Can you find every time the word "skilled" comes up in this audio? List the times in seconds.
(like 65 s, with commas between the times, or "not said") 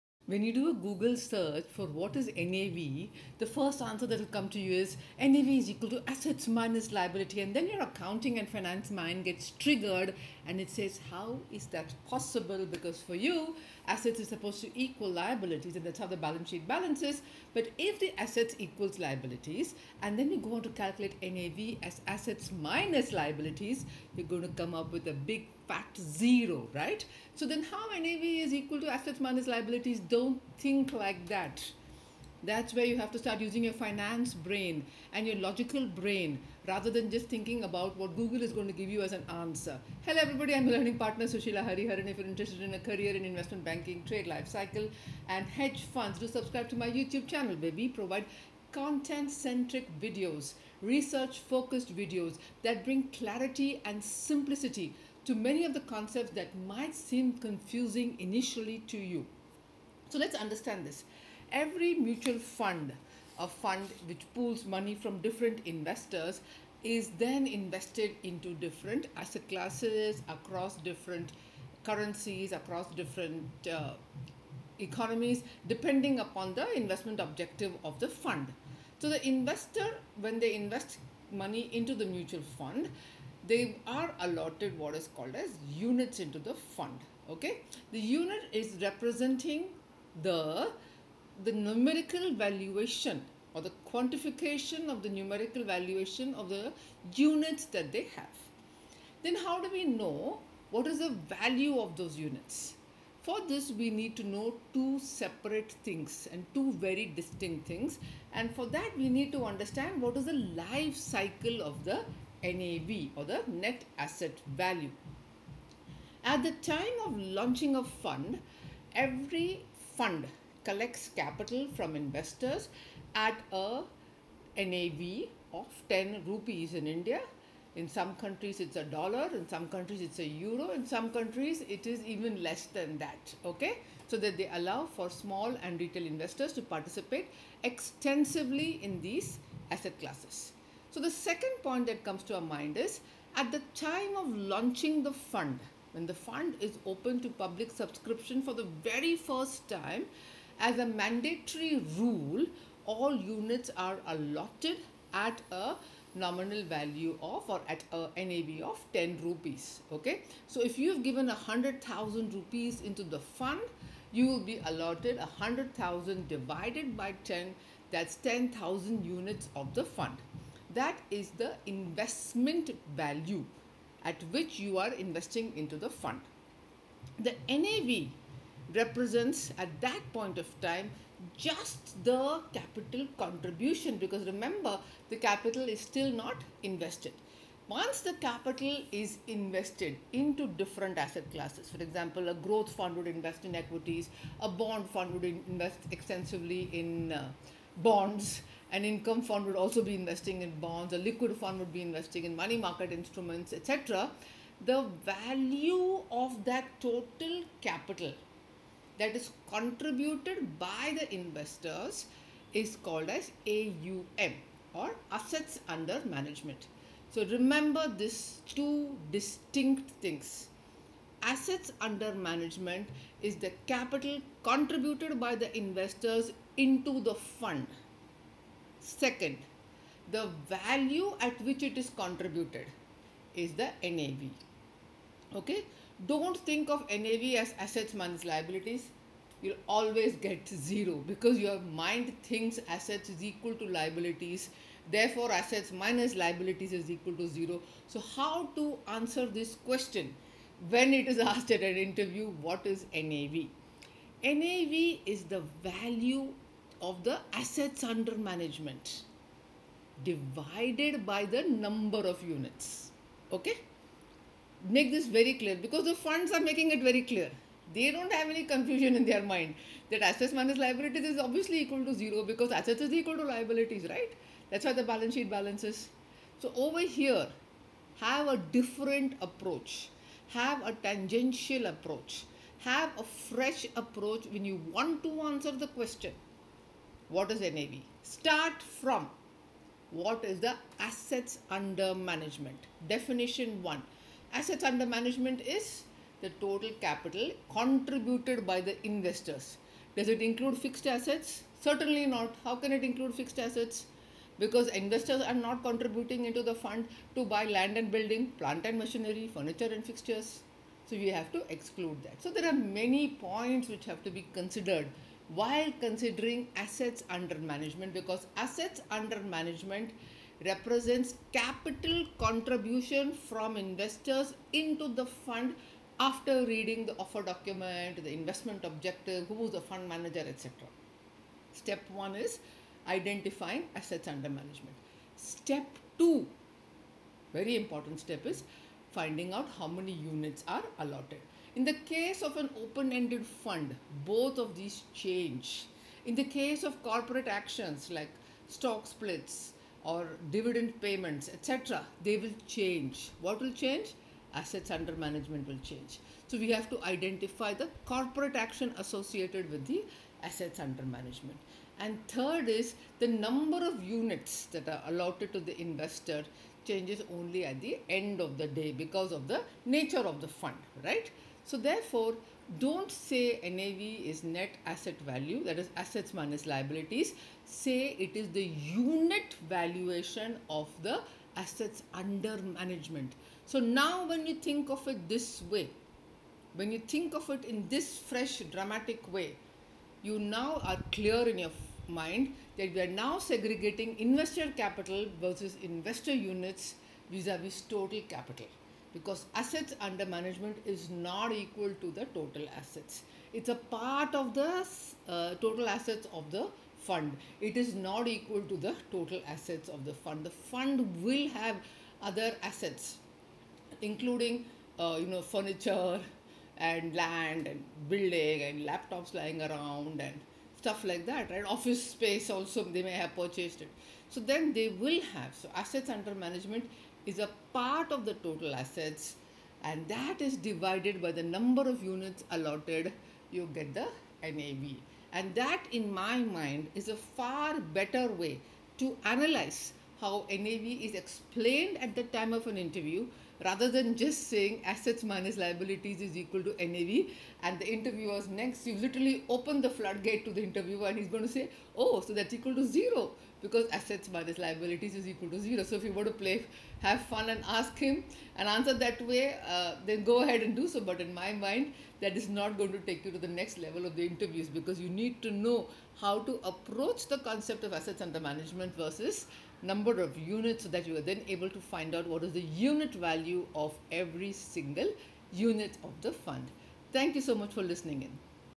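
not said.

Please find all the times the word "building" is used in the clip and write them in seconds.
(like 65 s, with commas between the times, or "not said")
307 s, 417 s.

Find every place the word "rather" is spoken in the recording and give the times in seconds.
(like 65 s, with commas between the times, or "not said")
36 s, 443 s.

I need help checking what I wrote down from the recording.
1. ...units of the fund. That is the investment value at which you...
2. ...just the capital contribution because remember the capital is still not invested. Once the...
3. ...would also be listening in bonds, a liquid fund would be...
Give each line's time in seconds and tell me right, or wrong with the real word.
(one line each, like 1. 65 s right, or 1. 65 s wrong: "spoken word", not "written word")
1. 169 s right
2. 181 s right
3. 199 s wrong: "investing", not "listening".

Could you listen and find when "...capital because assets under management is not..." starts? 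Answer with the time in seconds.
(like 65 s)
398 s.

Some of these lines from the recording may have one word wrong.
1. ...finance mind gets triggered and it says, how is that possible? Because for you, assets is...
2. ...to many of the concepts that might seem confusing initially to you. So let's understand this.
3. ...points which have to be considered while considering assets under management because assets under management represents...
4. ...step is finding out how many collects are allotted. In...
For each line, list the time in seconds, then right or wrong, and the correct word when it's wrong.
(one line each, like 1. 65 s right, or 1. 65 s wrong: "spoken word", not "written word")
1. 8 s right
2. 55 s right
3. 313 s right
4. 337 s wrong: "units", not "collects".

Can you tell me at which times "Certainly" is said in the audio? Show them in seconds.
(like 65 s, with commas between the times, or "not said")
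301 s.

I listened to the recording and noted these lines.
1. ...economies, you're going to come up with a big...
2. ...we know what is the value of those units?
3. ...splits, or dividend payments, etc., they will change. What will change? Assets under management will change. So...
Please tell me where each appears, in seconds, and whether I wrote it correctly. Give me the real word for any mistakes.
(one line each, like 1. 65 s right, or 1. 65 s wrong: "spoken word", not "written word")
1. 23 s wrong: "liabilities", not "economies"
2. 99 s right
3. 348 s right.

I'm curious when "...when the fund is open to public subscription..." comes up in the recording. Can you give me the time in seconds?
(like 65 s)
145 s.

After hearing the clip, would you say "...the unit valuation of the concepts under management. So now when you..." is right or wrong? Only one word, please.
wrong.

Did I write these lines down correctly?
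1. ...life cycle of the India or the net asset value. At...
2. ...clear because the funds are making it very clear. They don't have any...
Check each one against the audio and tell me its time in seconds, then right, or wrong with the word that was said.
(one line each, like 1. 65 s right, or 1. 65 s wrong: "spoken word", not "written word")
1. 110 s wrong: "NAV", not "India"
2. 265 s right.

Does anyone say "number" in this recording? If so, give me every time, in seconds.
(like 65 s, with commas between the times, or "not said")
261 s, 363 s, 431 s, 469 s.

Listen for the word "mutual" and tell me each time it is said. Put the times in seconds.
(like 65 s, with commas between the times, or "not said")
61 s, 82 s.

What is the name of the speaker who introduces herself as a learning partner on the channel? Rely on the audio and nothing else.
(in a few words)
Sushila Hariharan.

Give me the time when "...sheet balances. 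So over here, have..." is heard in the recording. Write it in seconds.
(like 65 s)
275 s.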